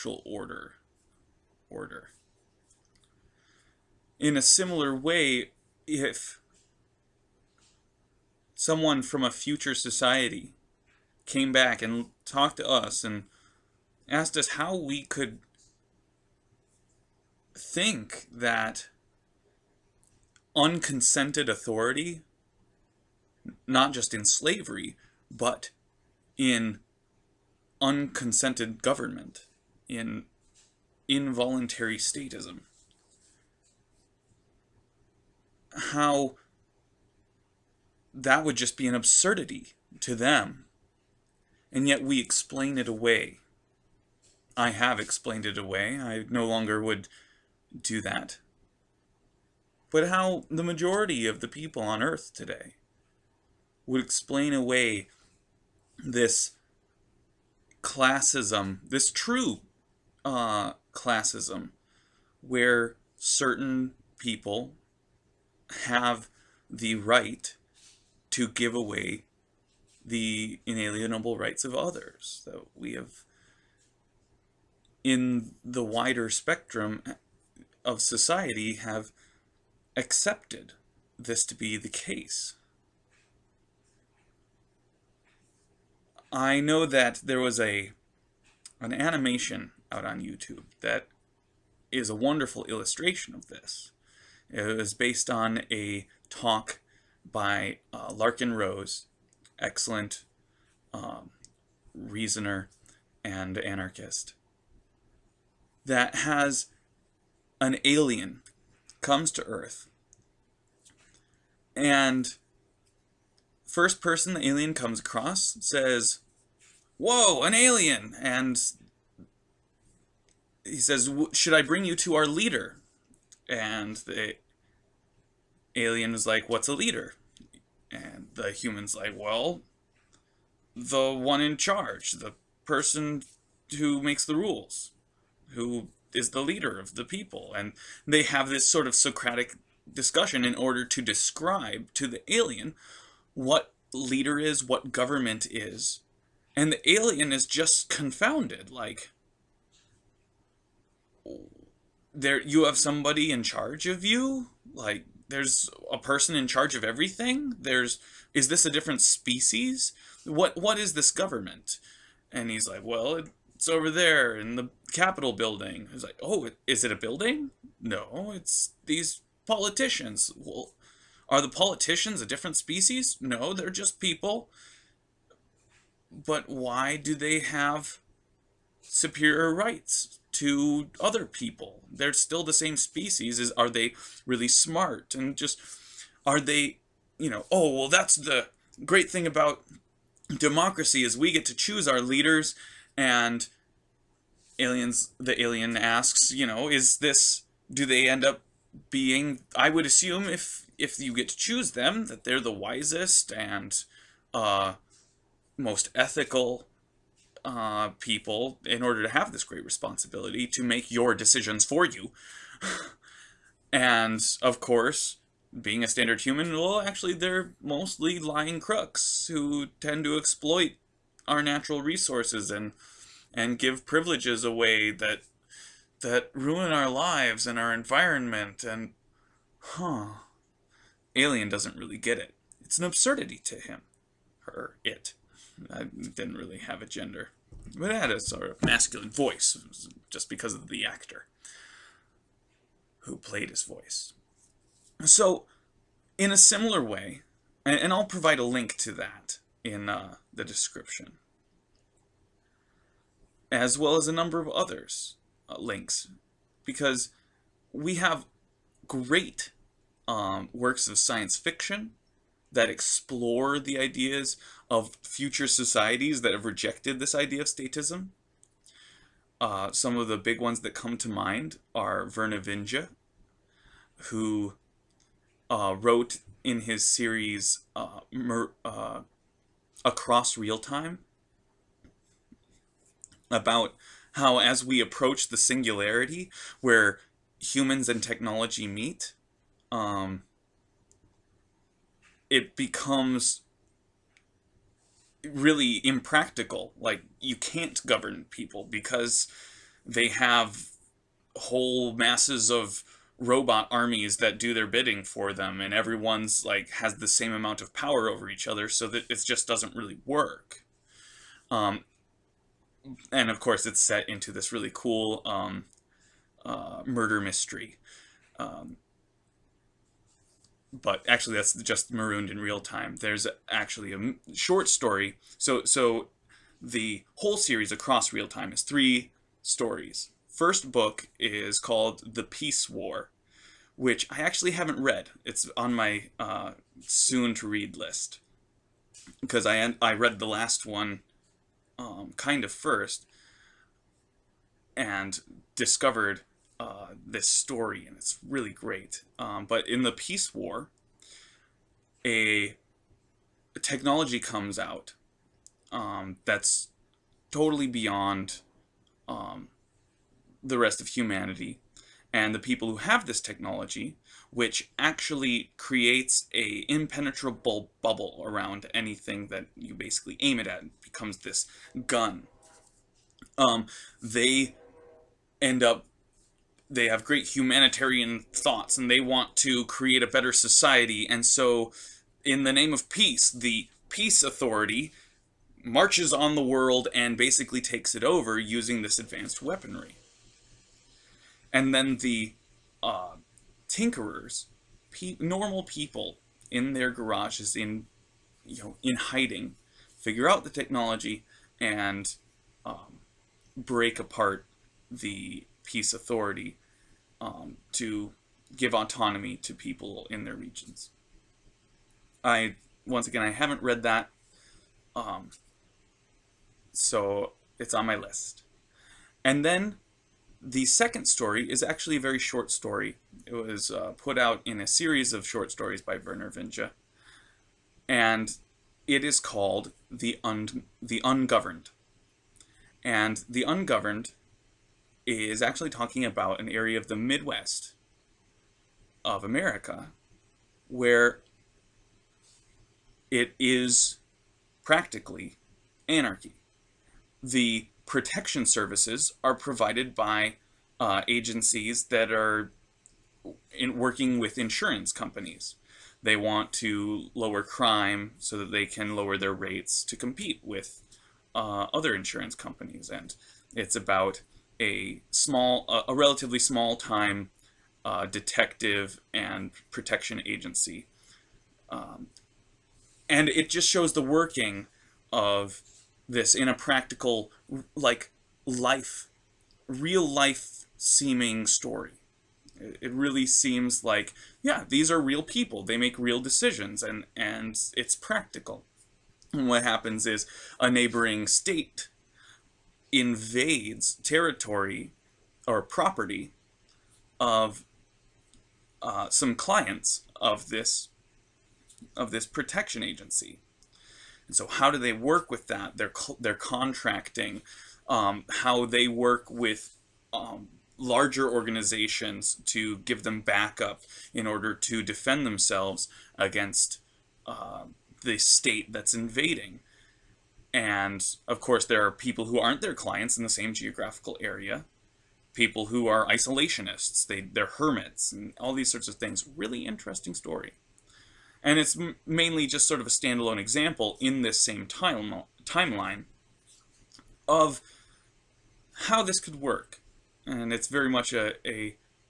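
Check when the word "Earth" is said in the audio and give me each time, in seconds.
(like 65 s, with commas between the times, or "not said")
52 s, 109 s.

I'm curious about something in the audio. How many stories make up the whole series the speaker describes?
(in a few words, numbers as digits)
3.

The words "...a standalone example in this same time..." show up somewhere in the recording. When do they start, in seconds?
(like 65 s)
532 s.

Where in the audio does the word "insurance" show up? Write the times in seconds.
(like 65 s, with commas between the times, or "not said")
454 s, 461 s.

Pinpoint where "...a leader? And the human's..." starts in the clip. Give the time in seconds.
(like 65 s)
126 s.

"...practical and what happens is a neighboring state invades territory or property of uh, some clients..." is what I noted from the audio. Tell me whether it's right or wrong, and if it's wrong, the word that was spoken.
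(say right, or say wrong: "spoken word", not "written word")
right.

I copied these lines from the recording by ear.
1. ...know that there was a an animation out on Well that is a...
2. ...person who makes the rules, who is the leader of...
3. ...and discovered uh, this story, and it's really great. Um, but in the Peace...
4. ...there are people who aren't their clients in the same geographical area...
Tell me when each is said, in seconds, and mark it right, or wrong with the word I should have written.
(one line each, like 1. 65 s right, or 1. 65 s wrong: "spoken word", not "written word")
1. 86 s wrong: "YouTube", not "Well"
2. 132 s right
3. 344 s right
4. 521 s right.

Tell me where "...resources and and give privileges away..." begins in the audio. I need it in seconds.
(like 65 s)
221 s.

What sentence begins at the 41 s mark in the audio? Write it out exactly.
And yet we explain it away.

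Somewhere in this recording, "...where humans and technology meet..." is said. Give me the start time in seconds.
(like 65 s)
286 s.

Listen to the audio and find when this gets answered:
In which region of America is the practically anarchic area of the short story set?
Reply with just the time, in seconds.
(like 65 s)
436 s.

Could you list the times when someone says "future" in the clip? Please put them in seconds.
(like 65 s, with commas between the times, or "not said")
9 s, 265 s.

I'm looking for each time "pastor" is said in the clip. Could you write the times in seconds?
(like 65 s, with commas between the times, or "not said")
not said.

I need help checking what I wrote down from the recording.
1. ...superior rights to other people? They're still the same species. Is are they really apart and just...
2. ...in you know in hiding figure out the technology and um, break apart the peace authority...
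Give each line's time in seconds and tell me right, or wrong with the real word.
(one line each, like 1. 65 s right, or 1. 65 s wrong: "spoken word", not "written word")
1. 178 s wrong: "smart", not "apart"
2. 397 s right.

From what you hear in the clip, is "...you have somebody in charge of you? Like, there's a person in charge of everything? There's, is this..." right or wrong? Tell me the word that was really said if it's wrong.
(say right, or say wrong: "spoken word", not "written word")
right.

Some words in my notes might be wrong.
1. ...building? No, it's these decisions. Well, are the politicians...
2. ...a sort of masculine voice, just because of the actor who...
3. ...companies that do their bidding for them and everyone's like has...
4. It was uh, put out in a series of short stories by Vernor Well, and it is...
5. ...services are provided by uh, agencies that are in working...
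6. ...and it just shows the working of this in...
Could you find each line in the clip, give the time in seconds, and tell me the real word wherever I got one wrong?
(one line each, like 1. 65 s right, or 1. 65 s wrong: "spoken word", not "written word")
1. 166 s wrong: "politicians", not "decisions"
2. 238 s right
3. 303 s wrong: "armies", not "companies"
4. 423 s wrong: "Vinge", not "Well"
5. 448 s right
6. 473 s right.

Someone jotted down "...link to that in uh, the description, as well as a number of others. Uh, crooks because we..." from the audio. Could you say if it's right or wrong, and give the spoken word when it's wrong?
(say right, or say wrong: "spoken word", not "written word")
wrong: "links", not "crooks".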